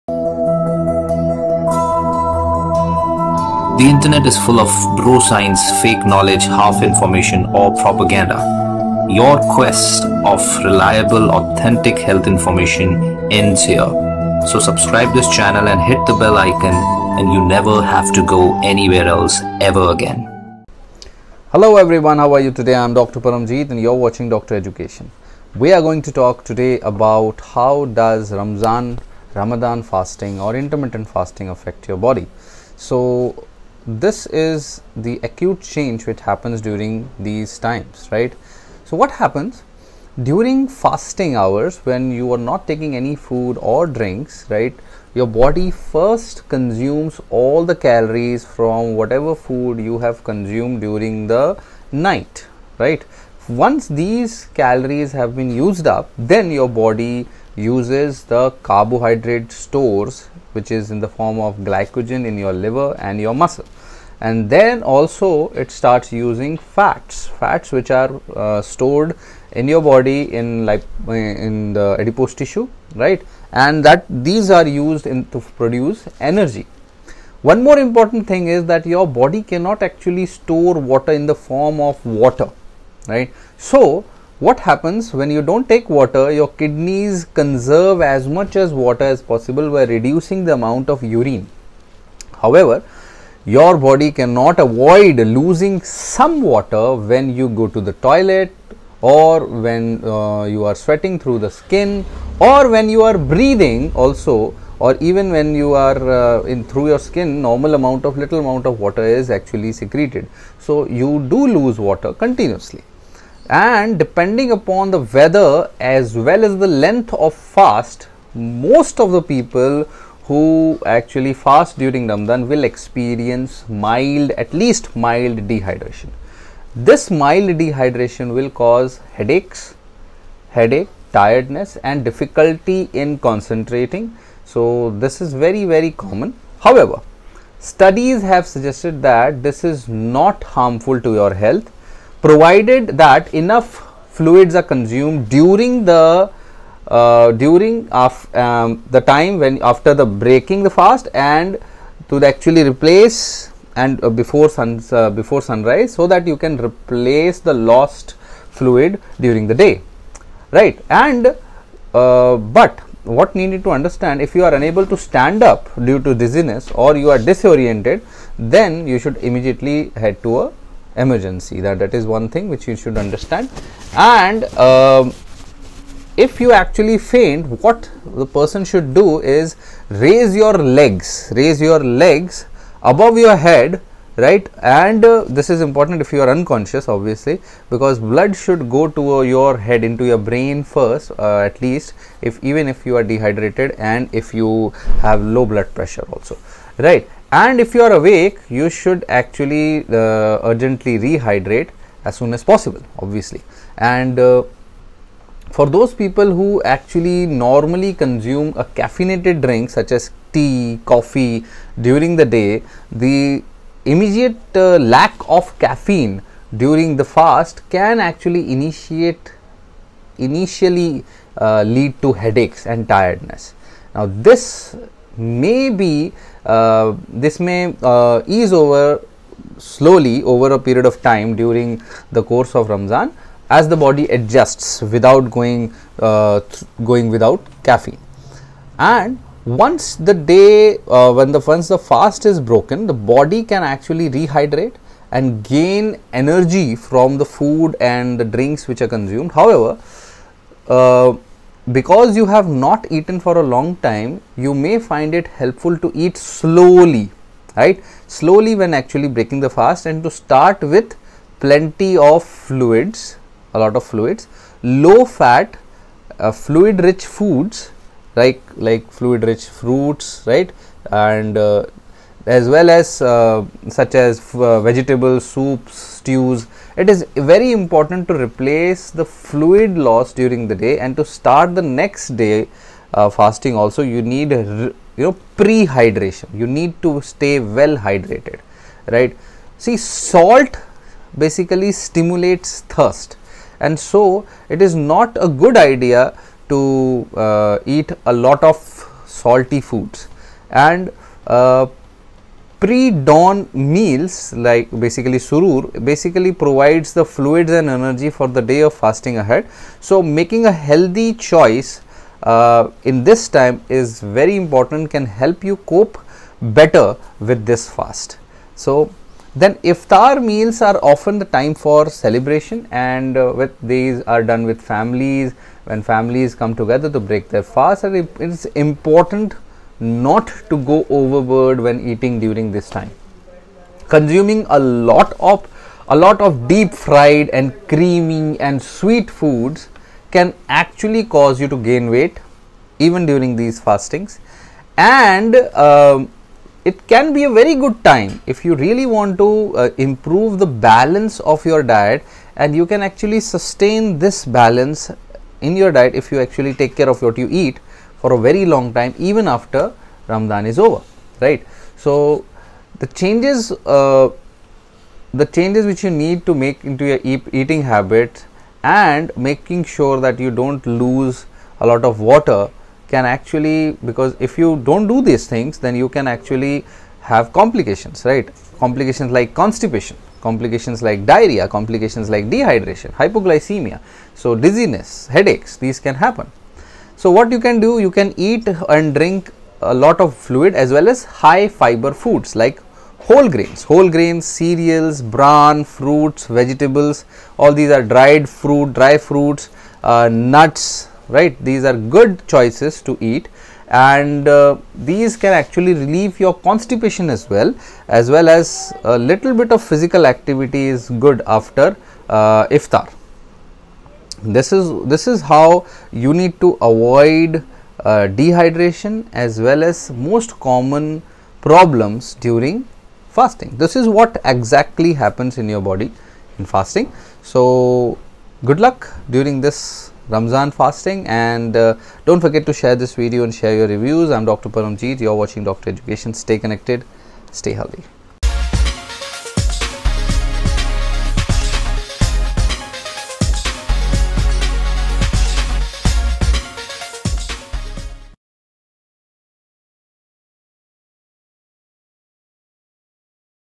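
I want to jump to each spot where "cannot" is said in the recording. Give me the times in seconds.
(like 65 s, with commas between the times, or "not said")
79 s, 94 s.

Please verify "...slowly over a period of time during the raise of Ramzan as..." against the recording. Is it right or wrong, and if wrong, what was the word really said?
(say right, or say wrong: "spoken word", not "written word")
wrong: "course", not "raise".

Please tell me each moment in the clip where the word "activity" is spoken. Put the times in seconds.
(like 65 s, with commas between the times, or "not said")
410 s.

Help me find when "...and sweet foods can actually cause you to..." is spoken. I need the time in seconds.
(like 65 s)
338 s.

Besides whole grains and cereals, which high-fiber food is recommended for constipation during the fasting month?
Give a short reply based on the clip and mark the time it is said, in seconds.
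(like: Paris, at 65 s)
bran, at 395 s.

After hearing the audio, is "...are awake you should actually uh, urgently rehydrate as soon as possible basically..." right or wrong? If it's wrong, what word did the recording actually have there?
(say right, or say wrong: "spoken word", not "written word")
wrong: "obviously", not "basically".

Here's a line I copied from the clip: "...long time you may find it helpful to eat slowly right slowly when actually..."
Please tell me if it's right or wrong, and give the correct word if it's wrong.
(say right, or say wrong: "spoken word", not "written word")
right.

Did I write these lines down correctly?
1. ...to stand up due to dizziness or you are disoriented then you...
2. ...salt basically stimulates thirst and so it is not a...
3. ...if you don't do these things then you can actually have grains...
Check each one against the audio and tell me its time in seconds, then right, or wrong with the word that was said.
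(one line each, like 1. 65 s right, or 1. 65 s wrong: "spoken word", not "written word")
1. 164 s right
2. 289 s right
3. 374 s wrong: "complications", not "grains".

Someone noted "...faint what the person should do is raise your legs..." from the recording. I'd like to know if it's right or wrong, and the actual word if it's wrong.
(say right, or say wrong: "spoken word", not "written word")
right.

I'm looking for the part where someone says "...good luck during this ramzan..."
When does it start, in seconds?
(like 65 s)
428 s.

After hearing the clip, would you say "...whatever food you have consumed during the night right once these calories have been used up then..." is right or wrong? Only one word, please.
right.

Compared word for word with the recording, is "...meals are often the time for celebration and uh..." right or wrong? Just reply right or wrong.
right.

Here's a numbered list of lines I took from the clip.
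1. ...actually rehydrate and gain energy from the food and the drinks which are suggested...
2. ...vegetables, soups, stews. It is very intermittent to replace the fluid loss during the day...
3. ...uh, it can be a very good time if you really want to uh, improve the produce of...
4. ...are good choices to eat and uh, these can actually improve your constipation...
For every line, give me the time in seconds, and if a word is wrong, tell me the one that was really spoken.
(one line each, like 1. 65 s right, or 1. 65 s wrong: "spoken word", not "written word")
1. 243 s wrong: "consumed", not "suggested"
2. 274 s wrong: "important", not "intermittent"
3. 345 s wrong: "balance", not "produce"
4. 401 s wrong: "relieve", not "improve".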